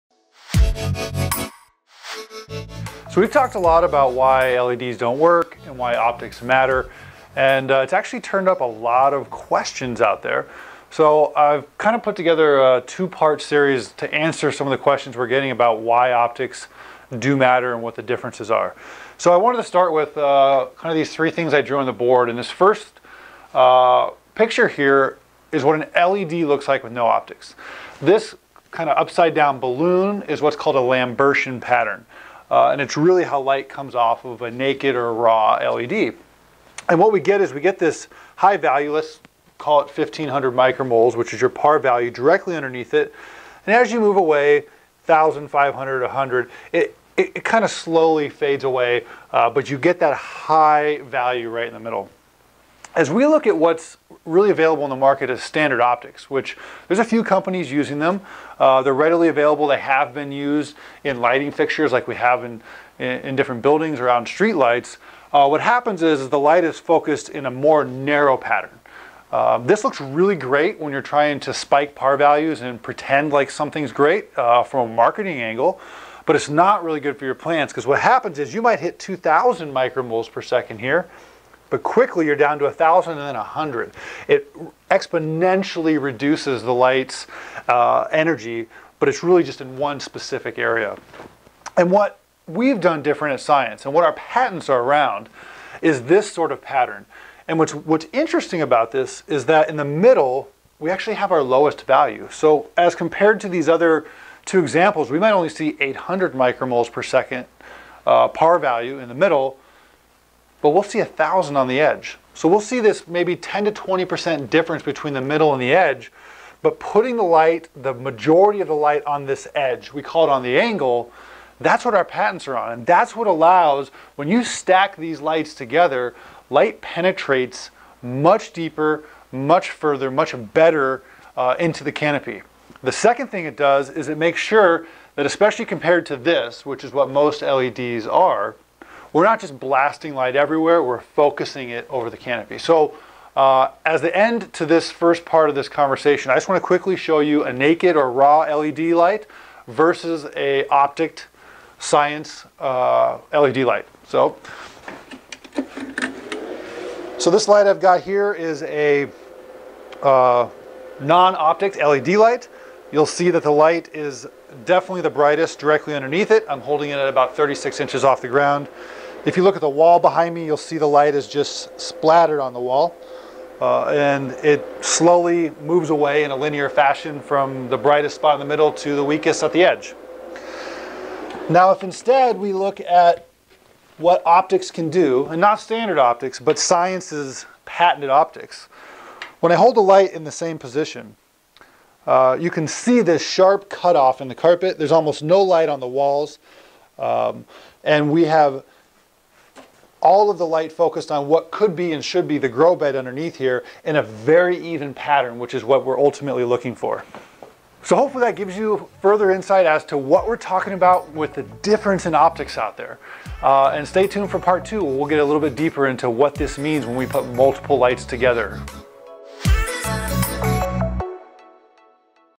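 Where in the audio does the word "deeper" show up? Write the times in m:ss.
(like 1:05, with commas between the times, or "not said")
2:08, 3:35.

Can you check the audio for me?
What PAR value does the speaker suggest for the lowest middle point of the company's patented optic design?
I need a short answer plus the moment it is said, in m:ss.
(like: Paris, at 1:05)
800 micromoles per second, at 1:45.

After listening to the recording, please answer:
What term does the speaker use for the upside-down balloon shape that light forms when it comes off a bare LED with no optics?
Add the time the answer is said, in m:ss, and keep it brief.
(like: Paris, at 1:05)
Lambertian pattern, at 0:30.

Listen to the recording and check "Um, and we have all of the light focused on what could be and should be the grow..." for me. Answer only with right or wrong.
right.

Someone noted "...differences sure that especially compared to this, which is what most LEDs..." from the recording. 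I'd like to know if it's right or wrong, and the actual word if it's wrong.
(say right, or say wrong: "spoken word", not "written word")
wrong: "makes", not "differences".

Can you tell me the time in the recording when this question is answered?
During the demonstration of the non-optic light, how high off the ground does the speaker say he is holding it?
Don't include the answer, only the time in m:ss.
2:47.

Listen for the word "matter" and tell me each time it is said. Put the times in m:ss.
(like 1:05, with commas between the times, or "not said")
0:06, 0:17.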